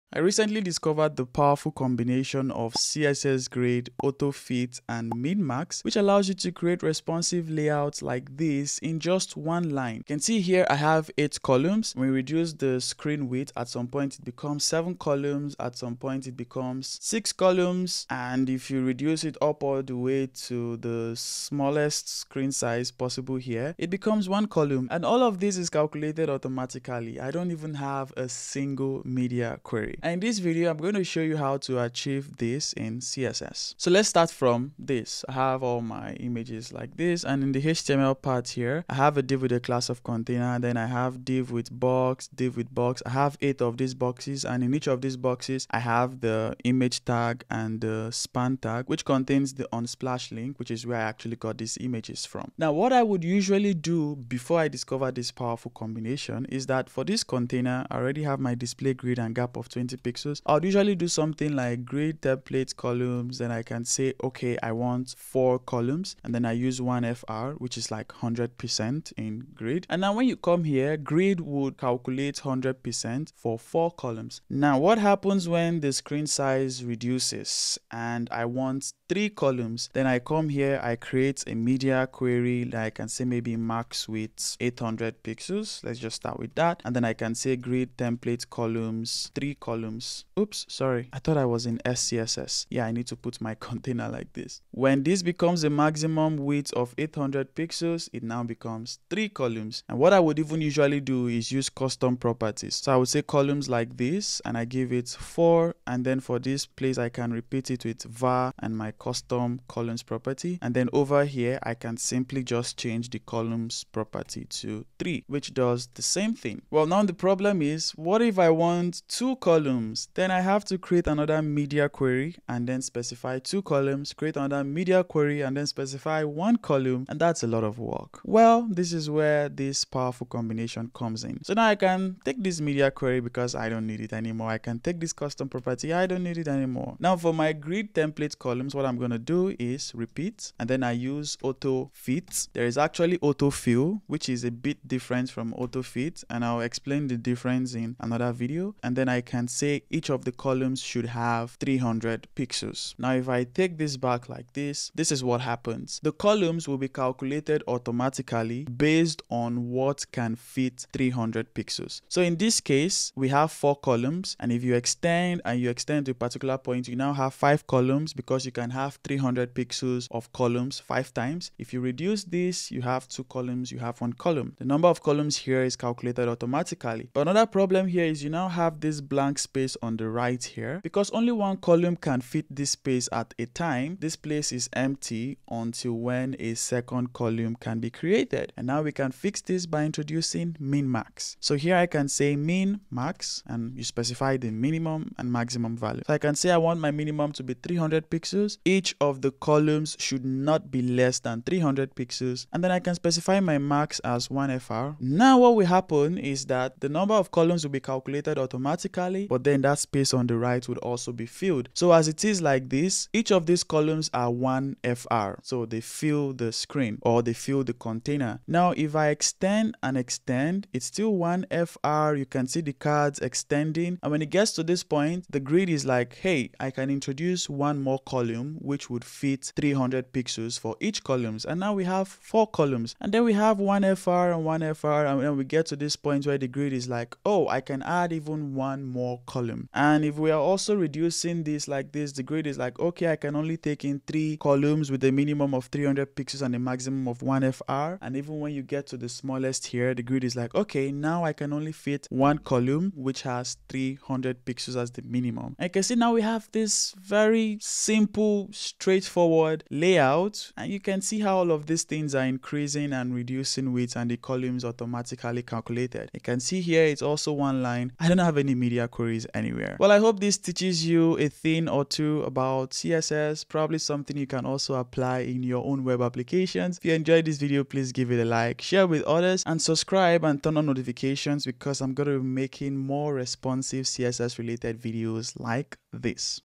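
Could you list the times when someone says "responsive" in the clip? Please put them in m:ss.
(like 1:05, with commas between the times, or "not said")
0:06, 4:43.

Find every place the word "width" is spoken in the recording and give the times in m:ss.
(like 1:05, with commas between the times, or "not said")
0:13, 1:24, 1:36, 4:23.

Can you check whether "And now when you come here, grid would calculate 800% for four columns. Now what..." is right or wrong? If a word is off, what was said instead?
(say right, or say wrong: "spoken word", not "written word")
wrong: "100", not "800".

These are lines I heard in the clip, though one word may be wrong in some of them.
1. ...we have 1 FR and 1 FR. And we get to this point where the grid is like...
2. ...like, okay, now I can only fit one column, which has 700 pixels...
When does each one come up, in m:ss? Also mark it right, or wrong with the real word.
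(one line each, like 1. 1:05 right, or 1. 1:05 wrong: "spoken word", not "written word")
1. 3:53 right
2. 4:10 wrong: "300", not "700".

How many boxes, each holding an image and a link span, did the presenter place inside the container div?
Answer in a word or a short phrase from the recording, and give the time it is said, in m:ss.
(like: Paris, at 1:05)
8, at 0:43.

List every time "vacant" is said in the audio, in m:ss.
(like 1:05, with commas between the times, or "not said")
not said.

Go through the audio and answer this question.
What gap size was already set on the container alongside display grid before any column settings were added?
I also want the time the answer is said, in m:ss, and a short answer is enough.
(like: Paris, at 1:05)
20 pixels, at 0:59.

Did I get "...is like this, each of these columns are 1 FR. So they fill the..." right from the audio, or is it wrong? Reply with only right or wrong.
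right.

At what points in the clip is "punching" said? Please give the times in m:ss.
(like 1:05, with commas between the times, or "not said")
not said.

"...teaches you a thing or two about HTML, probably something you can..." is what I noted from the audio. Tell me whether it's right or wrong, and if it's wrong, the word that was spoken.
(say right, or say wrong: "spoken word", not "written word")
wrong: "CSS", not "HTML".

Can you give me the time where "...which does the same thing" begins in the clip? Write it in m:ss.
1:55.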